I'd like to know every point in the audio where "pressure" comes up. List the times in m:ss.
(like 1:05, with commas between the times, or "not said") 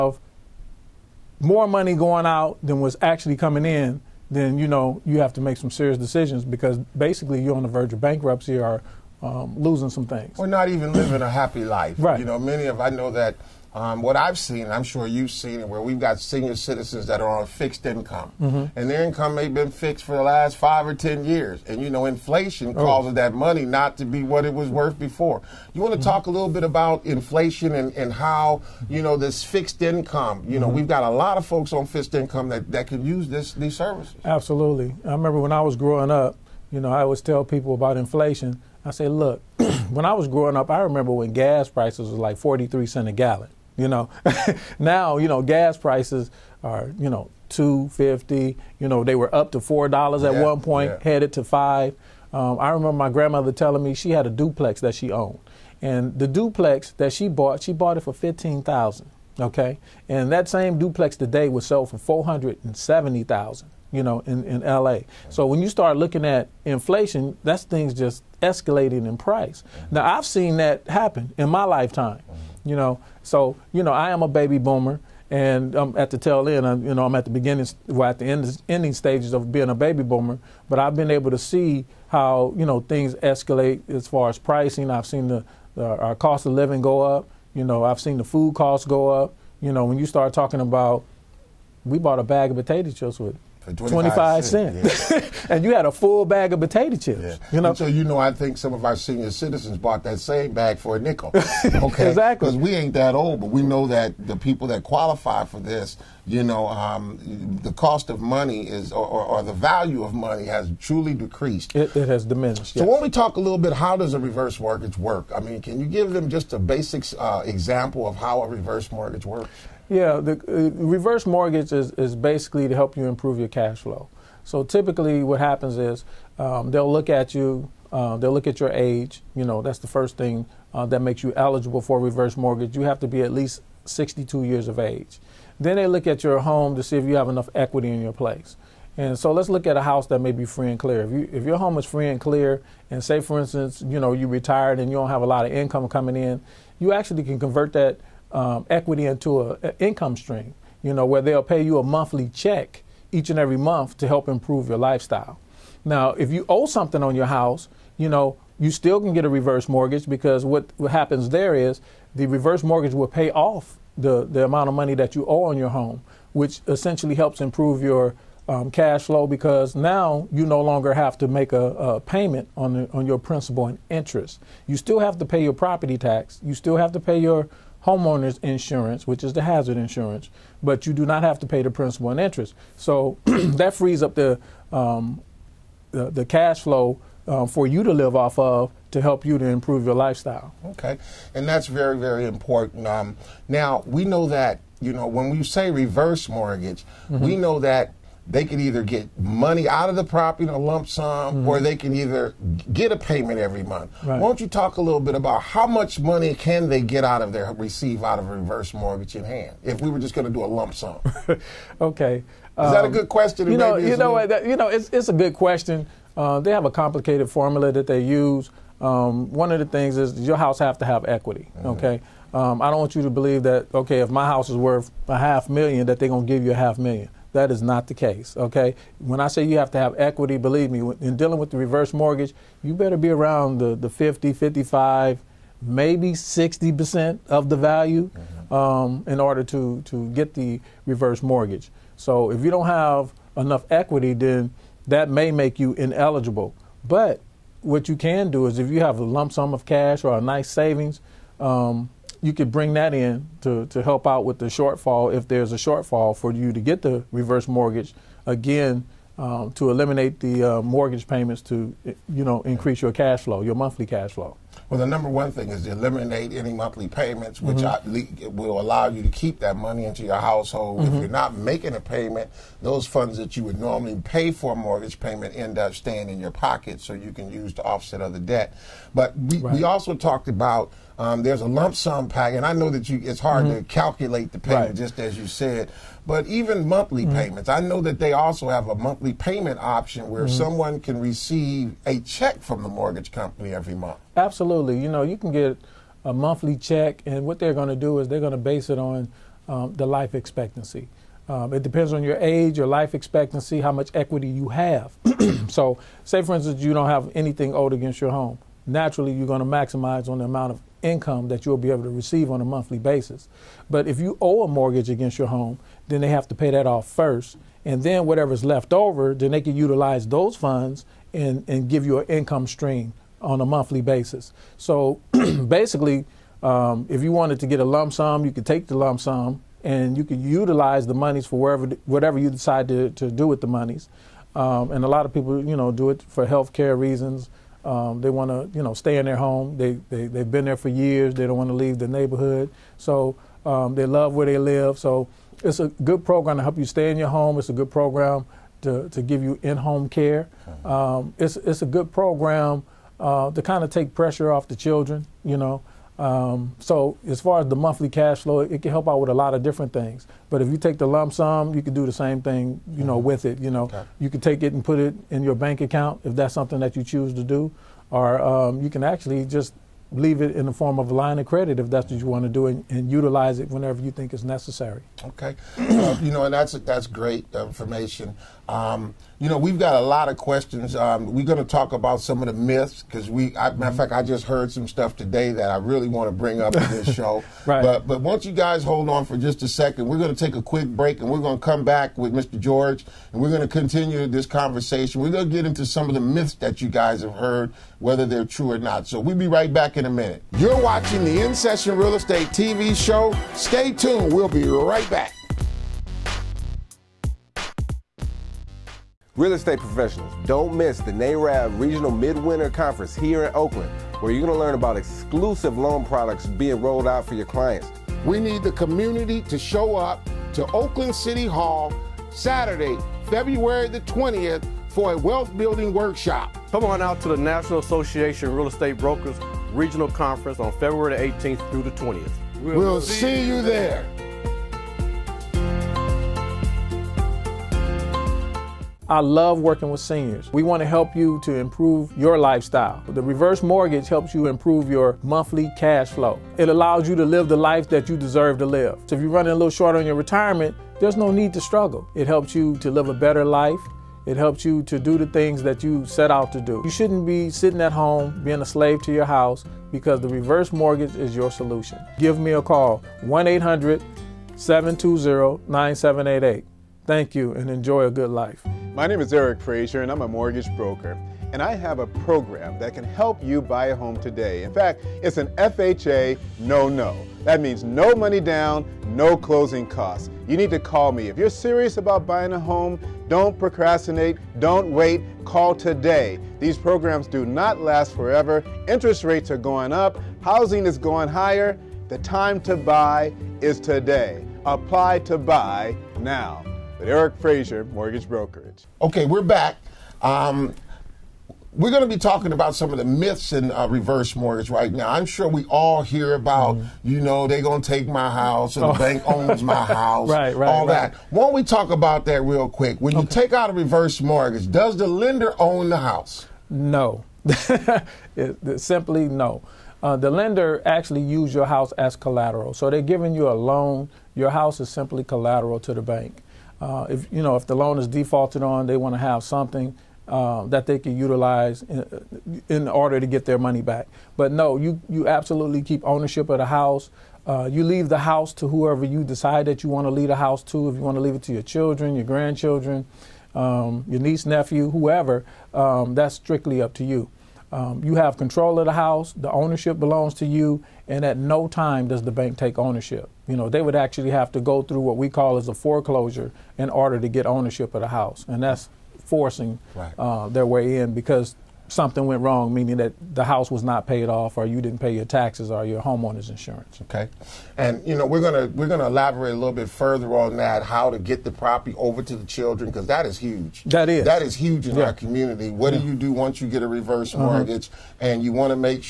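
5:53.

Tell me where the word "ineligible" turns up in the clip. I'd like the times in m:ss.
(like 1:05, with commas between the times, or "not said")
4:05.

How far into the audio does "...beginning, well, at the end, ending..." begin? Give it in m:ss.
1:17.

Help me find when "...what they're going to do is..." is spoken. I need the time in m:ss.
4:57.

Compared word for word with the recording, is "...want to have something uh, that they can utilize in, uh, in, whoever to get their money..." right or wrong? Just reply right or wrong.
wrong.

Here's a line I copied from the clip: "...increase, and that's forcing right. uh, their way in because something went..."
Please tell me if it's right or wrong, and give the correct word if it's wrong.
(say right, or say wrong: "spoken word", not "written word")
wrong: "house", not "increase".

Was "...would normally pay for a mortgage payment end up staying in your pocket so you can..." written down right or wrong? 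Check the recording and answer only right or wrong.
right.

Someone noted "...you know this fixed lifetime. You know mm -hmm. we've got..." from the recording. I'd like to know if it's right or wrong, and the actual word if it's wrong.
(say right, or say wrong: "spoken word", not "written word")
wrong: "income", not "lifetime".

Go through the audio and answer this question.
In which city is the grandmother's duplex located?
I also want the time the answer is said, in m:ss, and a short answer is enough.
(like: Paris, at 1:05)
LA, at 1:04.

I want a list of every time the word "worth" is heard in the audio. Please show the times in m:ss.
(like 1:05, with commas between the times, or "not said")
0:24, 3:44.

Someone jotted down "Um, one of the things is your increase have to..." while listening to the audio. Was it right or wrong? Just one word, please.
wrong.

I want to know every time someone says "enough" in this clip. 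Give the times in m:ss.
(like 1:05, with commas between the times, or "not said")
2:17, 4:03.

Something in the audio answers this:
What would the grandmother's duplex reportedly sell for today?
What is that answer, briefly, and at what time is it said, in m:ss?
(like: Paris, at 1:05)
$470,000, at 1:01.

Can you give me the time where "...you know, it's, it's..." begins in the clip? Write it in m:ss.
3:34.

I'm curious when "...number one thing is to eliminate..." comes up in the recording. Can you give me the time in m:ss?
4:24.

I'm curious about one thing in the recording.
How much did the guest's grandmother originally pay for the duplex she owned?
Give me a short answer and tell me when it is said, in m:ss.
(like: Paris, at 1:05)
$15,000, at 0:58.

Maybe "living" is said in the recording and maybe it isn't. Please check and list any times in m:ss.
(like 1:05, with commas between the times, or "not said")
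0:10, 1:26.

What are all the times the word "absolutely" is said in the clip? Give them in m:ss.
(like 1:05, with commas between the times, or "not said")
0:34, 4:54, 8:55.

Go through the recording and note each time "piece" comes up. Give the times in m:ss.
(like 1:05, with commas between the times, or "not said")
not said.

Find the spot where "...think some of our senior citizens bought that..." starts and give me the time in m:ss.
1:38.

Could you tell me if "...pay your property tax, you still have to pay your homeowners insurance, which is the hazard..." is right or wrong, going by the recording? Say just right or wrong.
right.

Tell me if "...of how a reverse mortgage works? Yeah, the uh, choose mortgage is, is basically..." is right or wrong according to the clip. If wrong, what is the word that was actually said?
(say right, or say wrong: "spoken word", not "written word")
wrong: "reverse", not "choose".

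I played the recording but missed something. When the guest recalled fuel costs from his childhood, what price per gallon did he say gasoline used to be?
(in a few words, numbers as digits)
43 cents.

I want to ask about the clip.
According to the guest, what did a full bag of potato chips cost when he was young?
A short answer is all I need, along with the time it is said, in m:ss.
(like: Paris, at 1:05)
25 cents, at 1:33.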